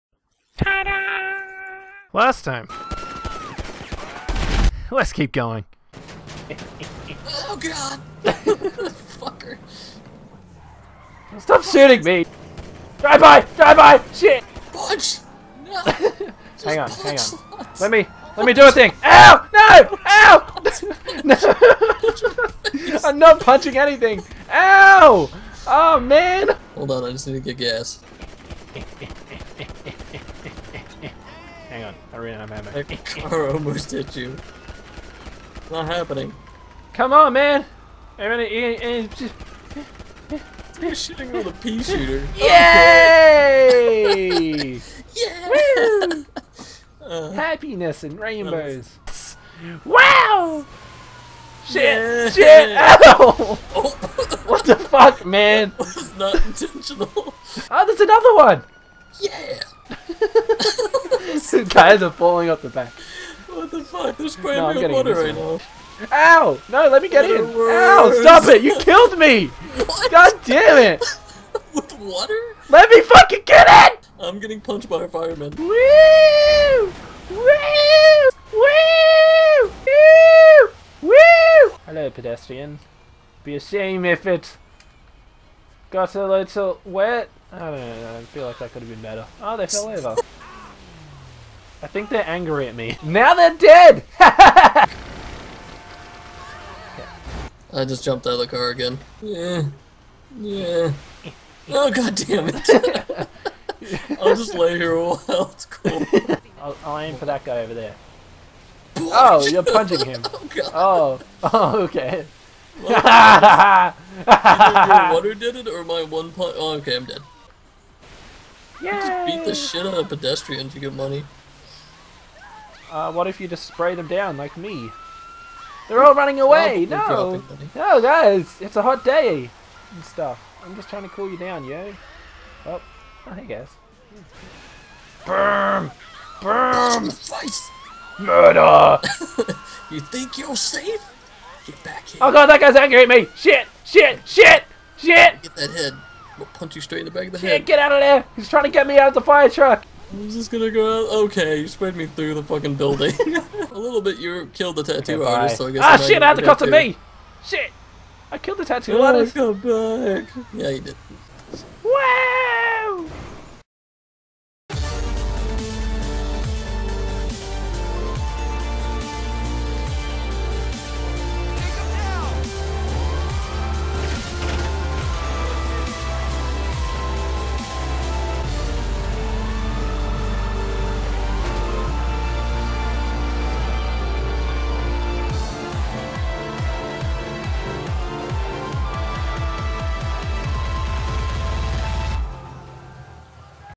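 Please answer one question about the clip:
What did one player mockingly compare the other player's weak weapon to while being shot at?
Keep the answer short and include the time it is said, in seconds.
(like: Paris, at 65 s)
pea shooter, at 41 s.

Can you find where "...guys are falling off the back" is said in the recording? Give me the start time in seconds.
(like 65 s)
61 s.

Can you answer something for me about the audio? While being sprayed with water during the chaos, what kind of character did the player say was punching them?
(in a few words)
fireman.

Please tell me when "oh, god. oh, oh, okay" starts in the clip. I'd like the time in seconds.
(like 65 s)
110 s.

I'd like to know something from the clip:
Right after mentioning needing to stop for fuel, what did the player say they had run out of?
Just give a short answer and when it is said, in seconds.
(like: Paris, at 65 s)
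ammo, at 32 s.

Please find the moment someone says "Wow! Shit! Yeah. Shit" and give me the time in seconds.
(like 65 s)
49 s.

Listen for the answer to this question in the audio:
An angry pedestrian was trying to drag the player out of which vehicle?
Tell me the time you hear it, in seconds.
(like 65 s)
149 s.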